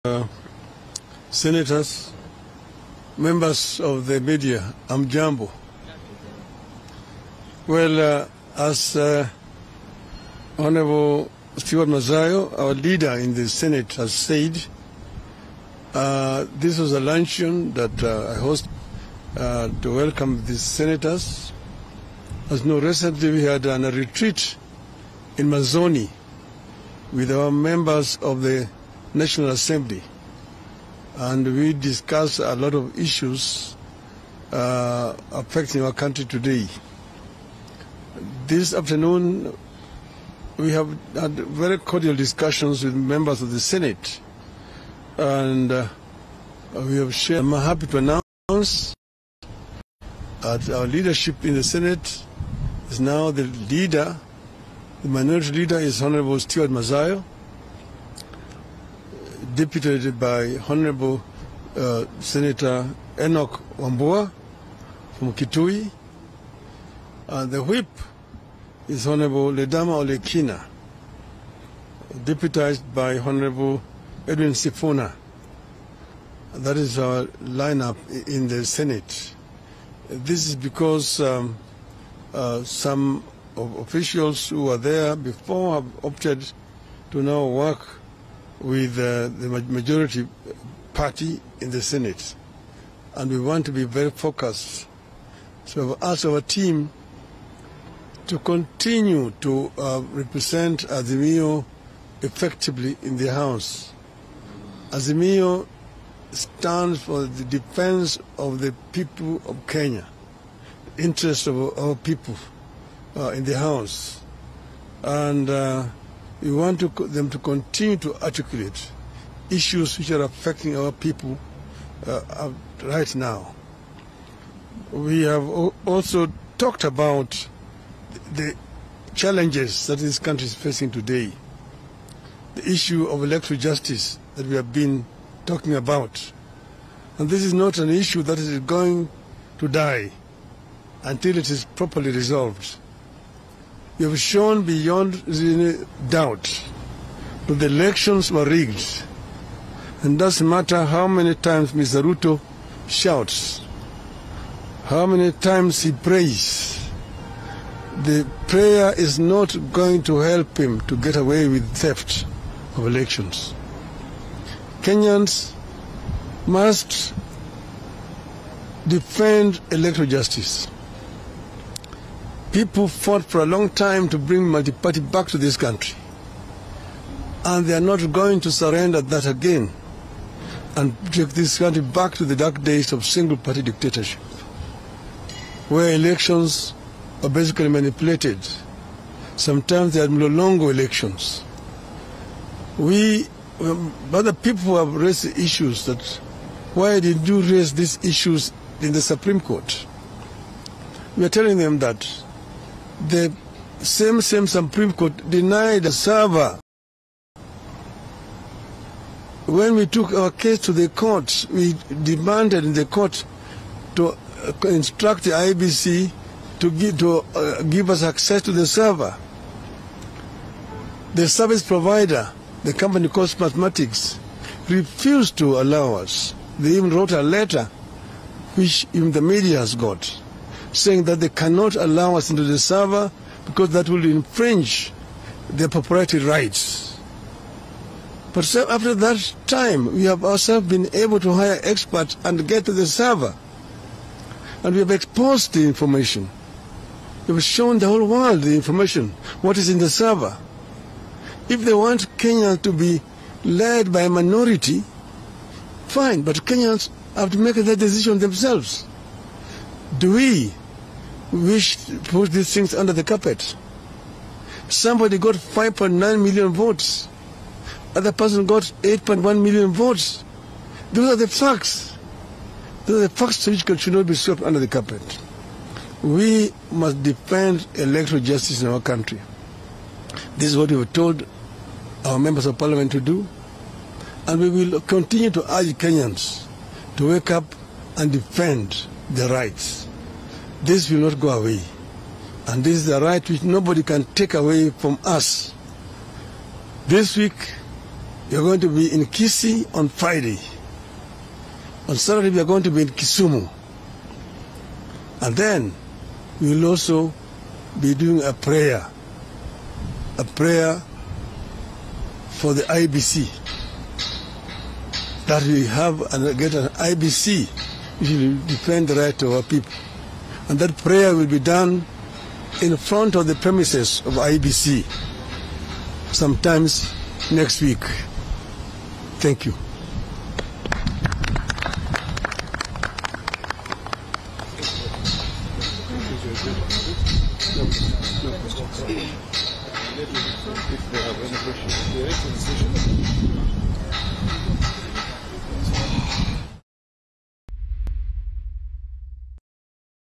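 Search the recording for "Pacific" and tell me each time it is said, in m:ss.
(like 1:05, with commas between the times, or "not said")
not said.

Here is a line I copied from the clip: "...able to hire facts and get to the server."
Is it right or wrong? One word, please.
wrong.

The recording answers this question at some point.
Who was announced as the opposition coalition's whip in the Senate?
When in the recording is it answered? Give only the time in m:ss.
1:09.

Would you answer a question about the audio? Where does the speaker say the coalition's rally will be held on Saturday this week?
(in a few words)
Kisumu.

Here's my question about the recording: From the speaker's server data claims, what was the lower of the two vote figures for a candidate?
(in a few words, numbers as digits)
5.9 million.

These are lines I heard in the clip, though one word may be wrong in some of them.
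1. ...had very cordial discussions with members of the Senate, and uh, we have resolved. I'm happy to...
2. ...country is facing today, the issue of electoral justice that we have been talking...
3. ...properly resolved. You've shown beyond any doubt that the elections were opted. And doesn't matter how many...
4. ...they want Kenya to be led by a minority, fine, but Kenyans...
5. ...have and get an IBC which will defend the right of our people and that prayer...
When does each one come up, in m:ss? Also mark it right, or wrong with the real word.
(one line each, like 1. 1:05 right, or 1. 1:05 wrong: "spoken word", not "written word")
1. 0:41 wrong: "shared", not "resolved"
2. 2:10 right
3. 2:21 wrong: "rigged", not "opted"
4. 4:11 right
5. 5:15 right.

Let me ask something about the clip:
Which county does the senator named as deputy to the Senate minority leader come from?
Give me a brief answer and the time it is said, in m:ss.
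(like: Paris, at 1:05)
Kitui, at 1:05.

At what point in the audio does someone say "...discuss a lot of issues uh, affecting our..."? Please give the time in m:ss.
0:31.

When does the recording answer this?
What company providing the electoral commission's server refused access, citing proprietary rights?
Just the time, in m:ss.
3:43.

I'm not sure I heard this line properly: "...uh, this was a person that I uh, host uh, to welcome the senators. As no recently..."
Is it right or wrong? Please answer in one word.
wrong.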